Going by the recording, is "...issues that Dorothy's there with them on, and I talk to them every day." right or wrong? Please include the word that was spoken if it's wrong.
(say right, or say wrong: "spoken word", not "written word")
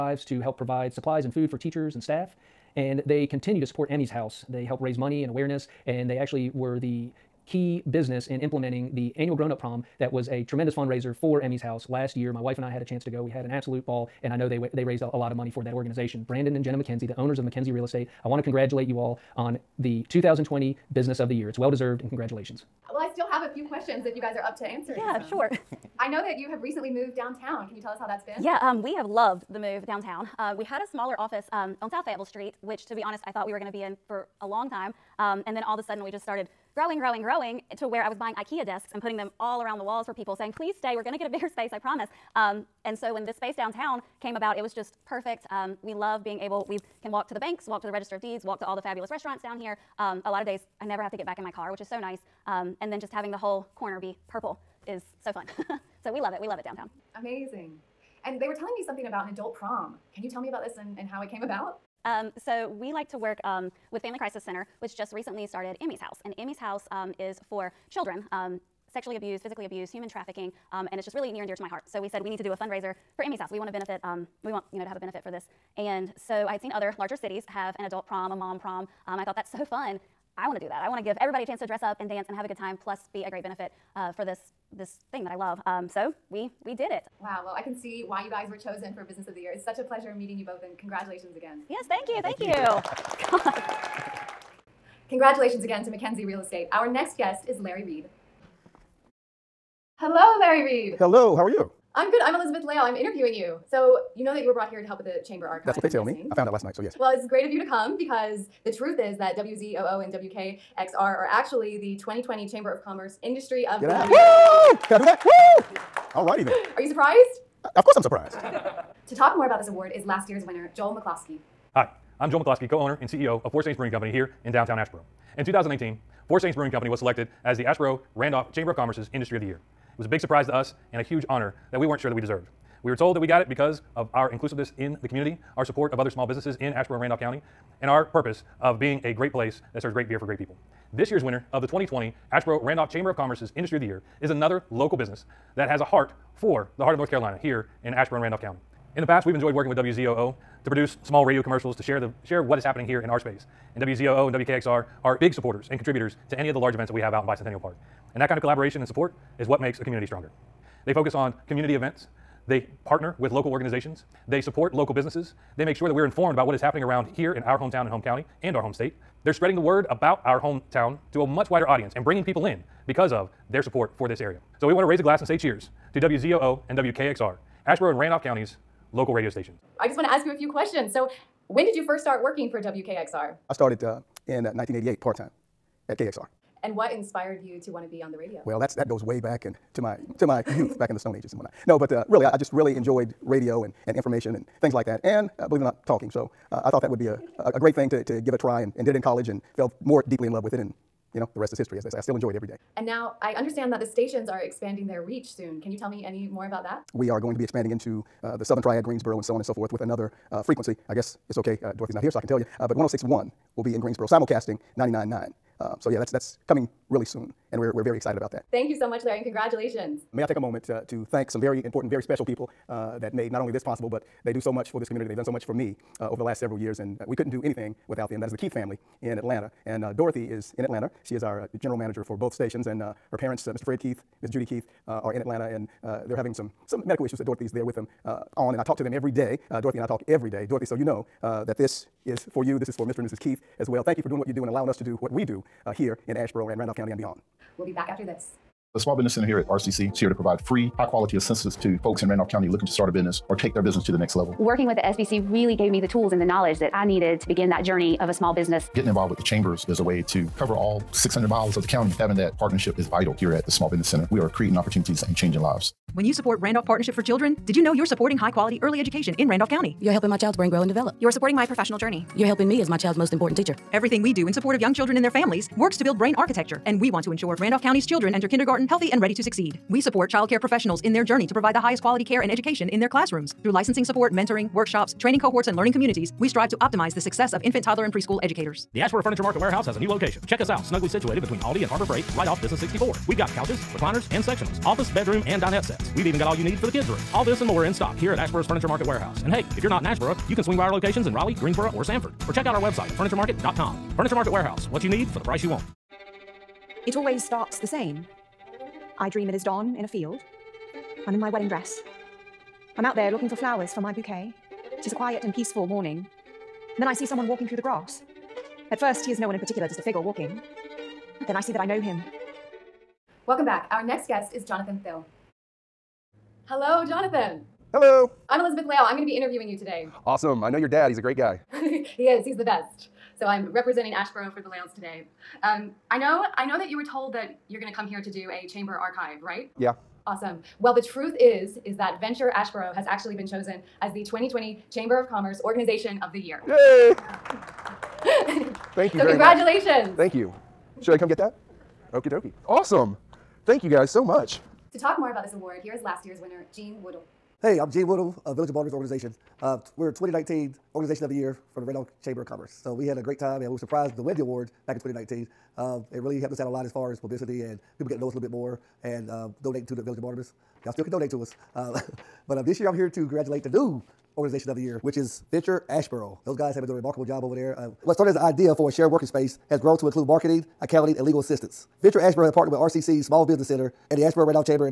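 right.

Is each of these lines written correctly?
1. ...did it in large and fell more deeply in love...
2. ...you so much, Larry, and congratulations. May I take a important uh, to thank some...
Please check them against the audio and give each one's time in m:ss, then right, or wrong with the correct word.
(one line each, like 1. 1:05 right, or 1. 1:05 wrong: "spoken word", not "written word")
1. 3:18 wrong: "college", not "large"
2. 3:38 wrong: "moment", not "important".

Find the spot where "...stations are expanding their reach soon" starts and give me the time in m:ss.
3:23.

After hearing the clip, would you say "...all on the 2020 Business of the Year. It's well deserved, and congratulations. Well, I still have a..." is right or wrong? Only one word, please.
right.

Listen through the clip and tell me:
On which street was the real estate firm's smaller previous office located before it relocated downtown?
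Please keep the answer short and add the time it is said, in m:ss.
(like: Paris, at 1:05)
South Fayetteville Street, at 0:31.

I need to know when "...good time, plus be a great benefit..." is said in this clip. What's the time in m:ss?
1:22.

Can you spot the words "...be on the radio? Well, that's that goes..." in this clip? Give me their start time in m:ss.
3:07.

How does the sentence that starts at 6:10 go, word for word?
Y'all still can donate to us.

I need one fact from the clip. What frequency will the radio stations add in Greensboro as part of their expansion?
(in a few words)
1061.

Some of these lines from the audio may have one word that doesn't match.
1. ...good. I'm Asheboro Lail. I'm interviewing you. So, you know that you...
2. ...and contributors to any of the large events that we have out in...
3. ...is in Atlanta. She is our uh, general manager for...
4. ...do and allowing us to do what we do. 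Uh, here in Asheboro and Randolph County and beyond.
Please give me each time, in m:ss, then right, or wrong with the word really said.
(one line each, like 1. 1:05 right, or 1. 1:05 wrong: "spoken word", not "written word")
1. 1:42 wrong: "Elizabeth", not "Asheboro"
2. 2:35 right
3. 3:50 right
4. 4:04 right.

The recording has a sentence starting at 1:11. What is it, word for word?
So we said we need to do a fundraiser for Emmy's house.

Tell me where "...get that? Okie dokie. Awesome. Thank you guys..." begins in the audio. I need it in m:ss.
5:51.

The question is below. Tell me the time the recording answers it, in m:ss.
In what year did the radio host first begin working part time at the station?
3:04.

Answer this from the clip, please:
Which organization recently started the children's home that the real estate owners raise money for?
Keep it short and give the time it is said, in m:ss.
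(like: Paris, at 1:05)
Family Crisis Center, at 1:04.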